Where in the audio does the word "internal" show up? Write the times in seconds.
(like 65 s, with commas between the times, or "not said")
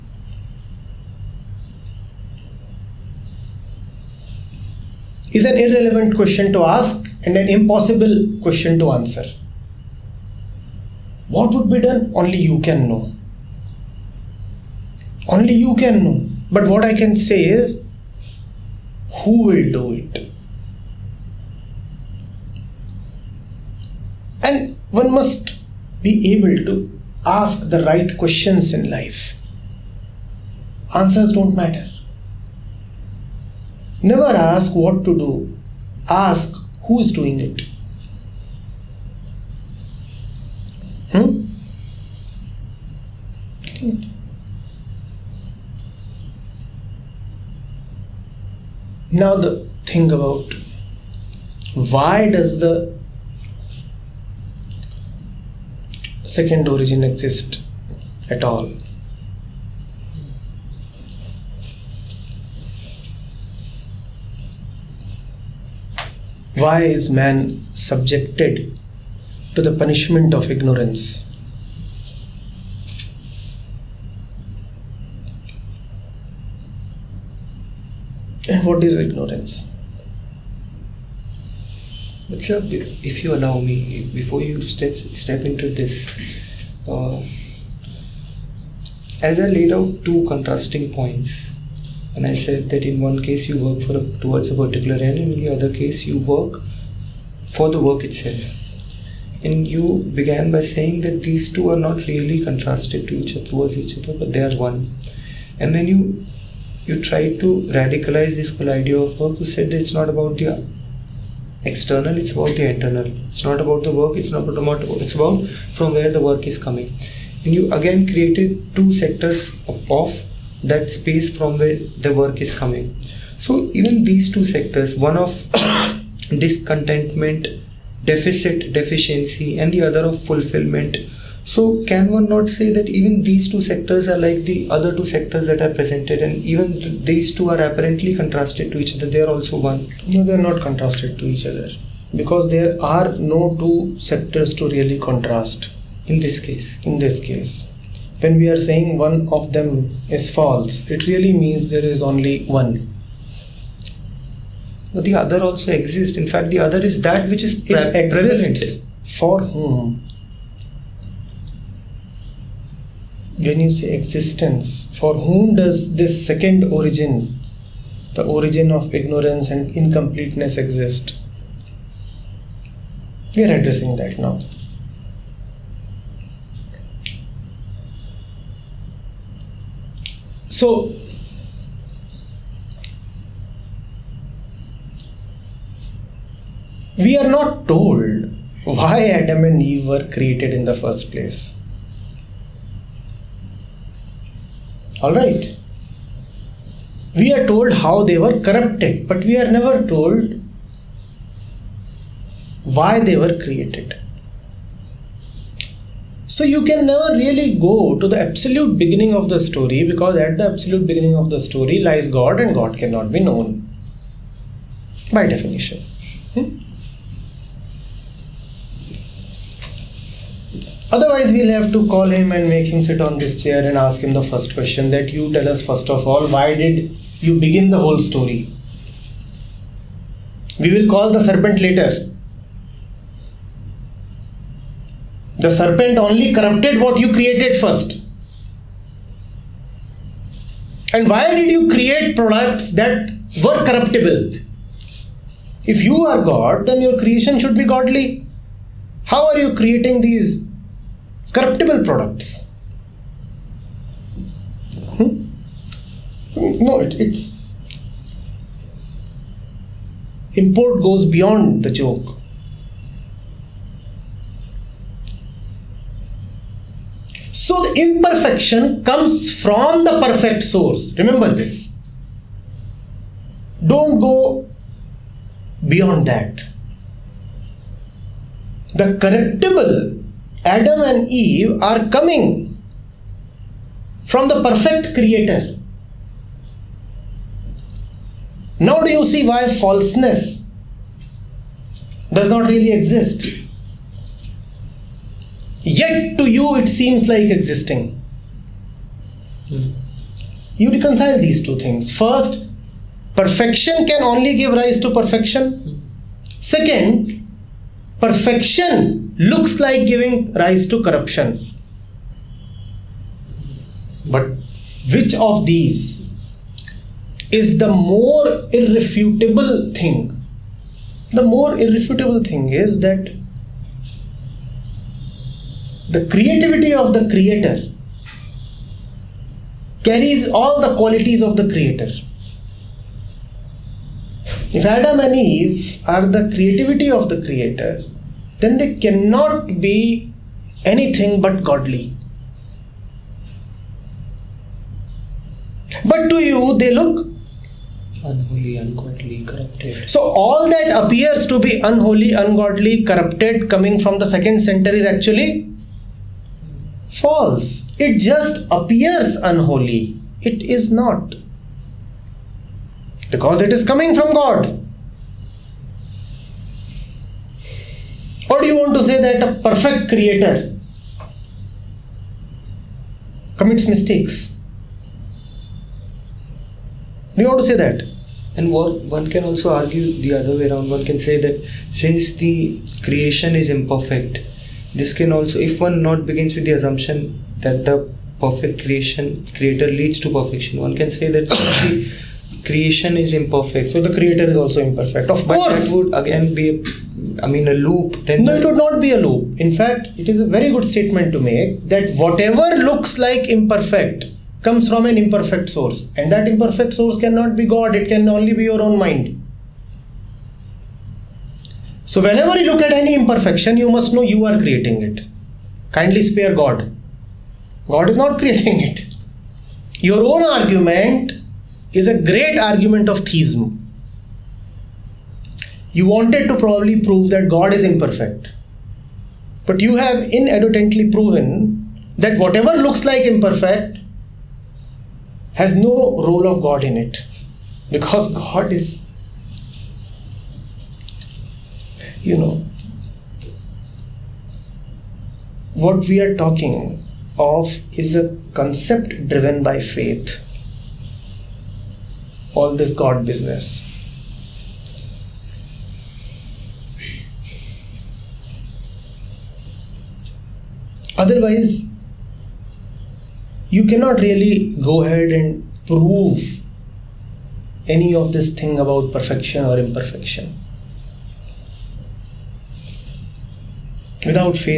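112 s.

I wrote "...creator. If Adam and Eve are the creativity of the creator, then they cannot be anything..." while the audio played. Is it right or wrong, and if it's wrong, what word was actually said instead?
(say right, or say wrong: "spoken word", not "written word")
right.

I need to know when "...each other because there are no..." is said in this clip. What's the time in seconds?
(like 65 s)
141 s.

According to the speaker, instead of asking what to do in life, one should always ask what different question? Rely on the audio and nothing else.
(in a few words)
who is doing it.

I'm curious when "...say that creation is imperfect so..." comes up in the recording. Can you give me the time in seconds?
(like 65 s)
390 s.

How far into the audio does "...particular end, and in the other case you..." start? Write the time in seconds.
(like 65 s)
94 s.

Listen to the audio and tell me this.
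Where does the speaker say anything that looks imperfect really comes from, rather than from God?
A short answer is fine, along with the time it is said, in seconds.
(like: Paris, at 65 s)
your own mind, at 408 s.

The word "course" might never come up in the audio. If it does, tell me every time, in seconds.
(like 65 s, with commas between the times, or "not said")
395 s.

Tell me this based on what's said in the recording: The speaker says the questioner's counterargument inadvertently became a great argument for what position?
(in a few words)
theism.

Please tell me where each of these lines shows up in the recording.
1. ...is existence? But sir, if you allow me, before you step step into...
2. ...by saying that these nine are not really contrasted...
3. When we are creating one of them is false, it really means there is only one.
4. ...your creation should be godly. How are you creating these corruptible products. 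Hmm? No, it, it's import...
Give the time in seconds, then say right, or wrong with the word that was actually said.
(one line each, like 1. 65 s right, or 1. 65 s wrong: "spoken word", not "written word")
1. 78 s wrong: "ignorance", not "existence"
2. 100 s wrong: "two", not "nine"
3. 148 s wrong: "saying", not "creating"
4. 246 s right.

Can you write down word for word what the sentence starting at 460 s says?
Otherwise, you cannot really go ahead and prove any of this thing about perfection or imperfection.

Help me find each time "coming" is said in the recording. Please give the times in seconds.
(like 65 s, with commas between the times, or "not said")
116 s, 122 s, 281 s, 353 s, 363 s.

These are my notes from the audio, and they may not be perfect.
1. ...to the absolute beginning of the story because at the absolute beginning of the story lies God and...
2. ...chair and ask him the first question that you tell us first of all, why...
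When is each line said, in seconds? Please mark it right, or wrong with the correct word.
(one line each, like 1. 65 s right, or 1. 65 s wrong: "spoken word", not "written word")
1. 208 s right
2. 223 s right.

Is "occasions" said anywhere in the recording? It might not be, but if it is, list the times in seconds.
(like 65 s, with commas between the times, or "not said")
not said.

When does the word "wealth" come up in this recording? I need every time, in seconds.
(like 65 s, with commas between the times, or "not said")
not said.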